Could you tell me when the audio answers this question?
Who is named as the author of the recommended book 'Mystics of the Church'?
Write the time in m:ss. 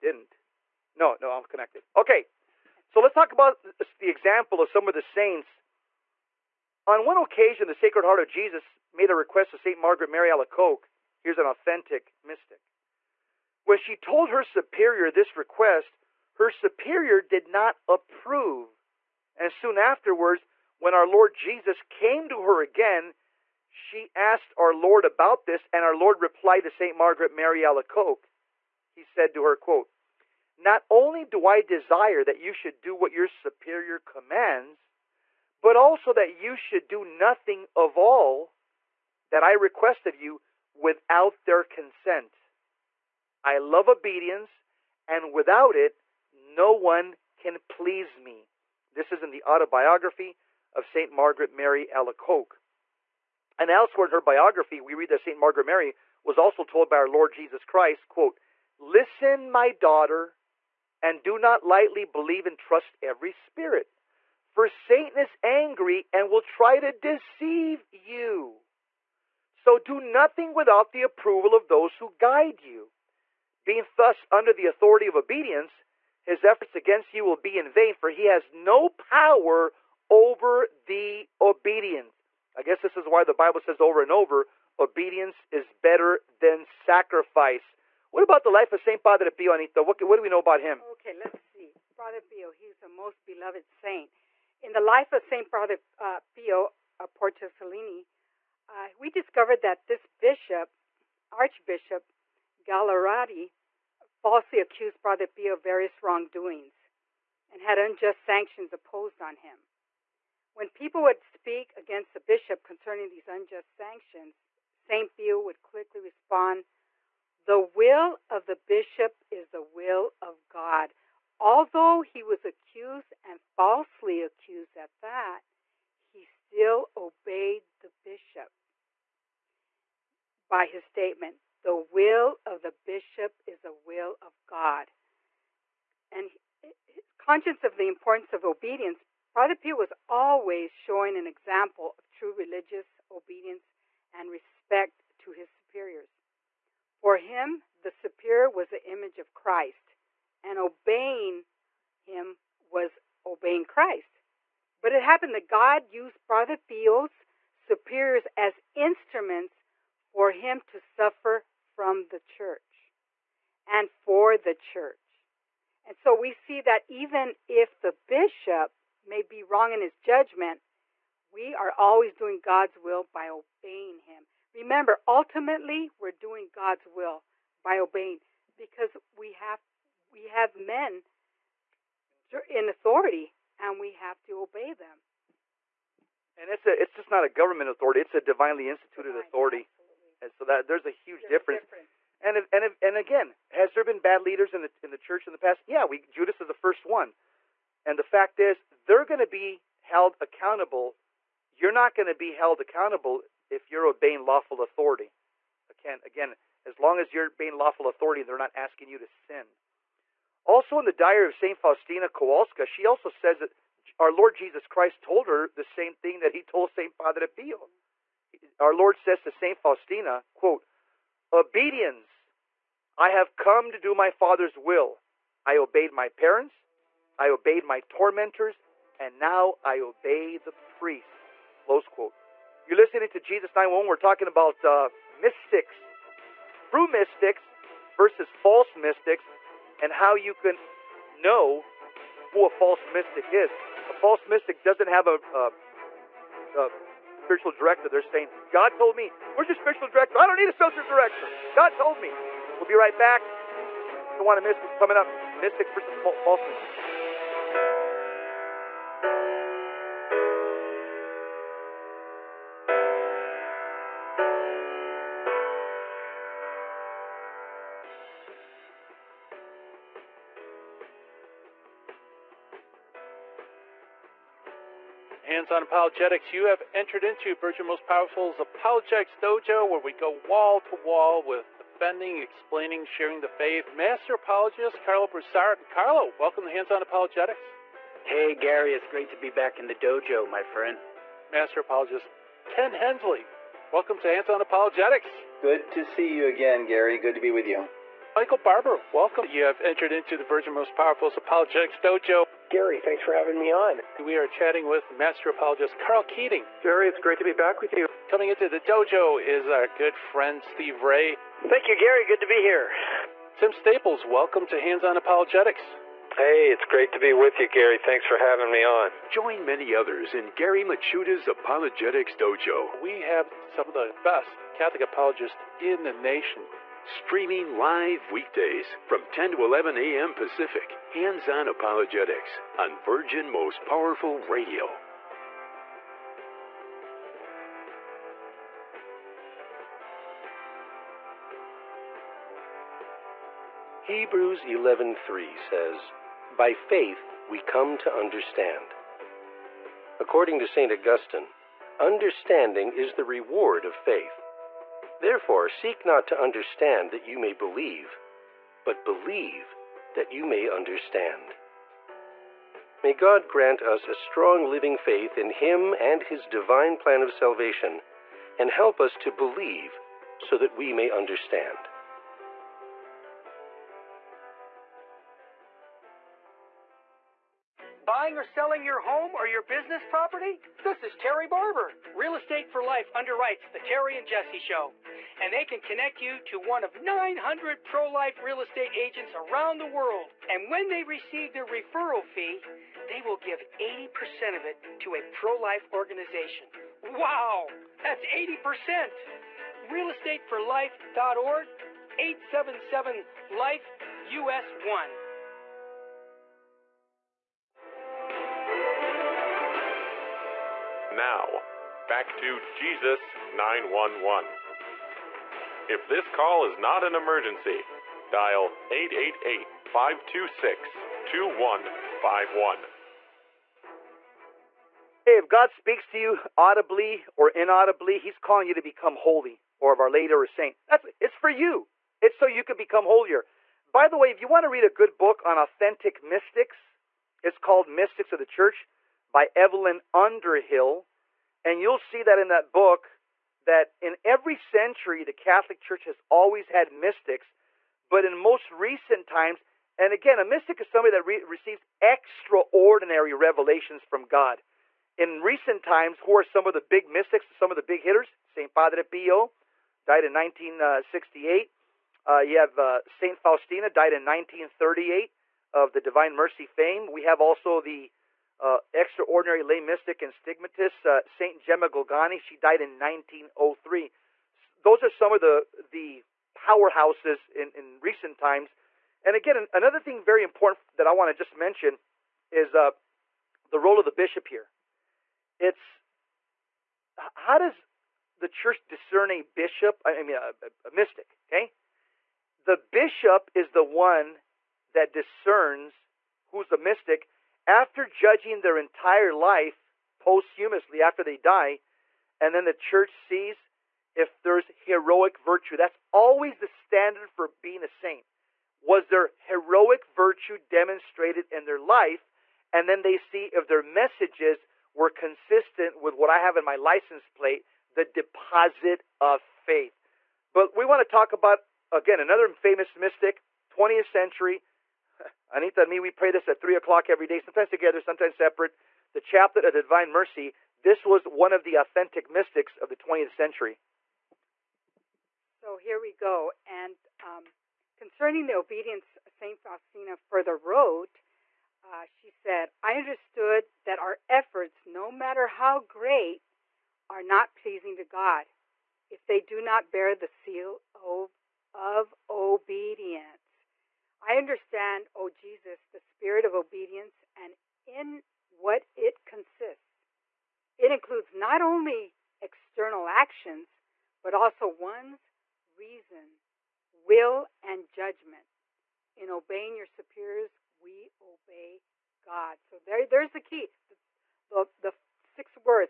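7:19.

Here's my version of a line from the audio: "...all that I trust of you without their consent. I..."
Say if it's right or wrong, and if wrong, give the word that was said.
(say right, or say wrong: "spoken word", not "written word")
wrong: "request", not "trust".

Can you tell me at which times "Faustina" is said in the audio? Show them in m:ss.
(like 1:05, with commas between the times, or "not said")
3:31, 3:39, 7:43, 8:59.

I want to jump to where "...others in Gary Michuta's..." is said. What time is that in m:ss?
5:19.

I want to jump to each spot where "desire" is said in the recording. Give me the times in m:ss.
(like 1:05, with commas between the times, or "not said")
0:31.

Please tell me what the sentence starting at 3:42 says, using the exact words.
I have come to do my Father's will.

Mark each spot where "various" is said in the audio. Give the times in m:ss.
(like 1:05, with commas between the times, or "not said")
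1:45.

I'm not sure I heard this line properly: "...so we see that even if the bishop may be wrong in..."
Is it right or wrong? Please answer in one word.
right.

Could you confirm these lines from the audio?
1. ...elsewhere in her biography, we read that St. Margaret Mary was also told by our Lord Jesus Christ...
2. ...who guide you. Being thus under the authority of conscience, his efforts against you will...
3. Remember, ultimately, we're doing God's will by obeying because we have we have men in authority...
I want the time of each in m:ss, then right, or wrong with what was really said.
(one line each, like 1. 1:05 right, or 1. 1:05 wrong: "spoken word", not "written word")
1. 0:53 right
2. 1:11 wrong: "obedience", not "conscience"
3. 2:54 right.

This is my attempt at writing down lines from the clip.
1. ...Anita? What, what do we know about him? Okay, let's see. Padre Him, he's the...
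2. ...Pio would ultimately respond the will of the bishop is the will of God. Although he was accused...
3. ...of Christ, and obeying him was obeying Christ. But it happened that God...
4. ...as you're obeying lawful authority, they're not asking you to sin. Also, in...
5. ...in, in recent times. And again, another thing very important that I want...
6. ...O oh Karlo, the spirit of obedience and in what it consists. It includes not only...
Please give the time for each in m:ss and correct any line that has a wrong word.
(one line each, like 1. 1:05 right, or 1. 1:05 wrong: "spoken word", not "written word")
1. 1:29 wrong: "Pio", not "Him"
2. 1:55 wrong: "quickly", not "ultimately"
3. 2:29 right
4. 3:26 right
5. 7:57 right
6. 9:14 wrong: "Jesus", not "Karlo".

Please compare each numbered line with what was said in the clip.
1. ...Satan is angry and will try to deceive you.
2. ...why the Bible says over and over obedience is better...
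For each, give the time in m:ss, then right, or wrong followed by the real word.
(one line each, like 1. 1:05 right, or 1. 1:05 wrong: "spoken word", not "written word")
1. 1:04 right
2. 1:23 right.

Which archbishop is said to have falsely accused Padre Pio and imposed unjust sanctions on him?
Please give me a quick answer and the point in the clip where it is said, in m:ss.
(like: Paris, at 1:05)
Archbishop Gagliardi, at 1:41.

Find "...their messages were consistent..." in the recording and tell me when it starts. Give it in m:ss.
8:33.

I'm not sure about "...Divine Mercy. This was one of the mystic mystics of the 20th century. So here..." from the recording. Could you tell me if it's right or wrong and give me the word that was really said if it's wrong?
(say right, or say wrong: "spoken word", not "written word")
wrong: "authentic", not "mystic".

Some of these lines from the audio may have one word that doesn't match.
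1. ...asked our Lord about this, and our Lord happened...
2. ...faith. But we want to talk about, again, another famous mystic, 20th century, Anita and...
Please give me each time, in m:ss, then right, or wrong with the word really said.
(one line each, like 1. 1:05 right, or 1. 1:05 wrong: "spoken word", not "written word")
1. 0:24 wrong: "replied", not "happened"
2. 8:39 right.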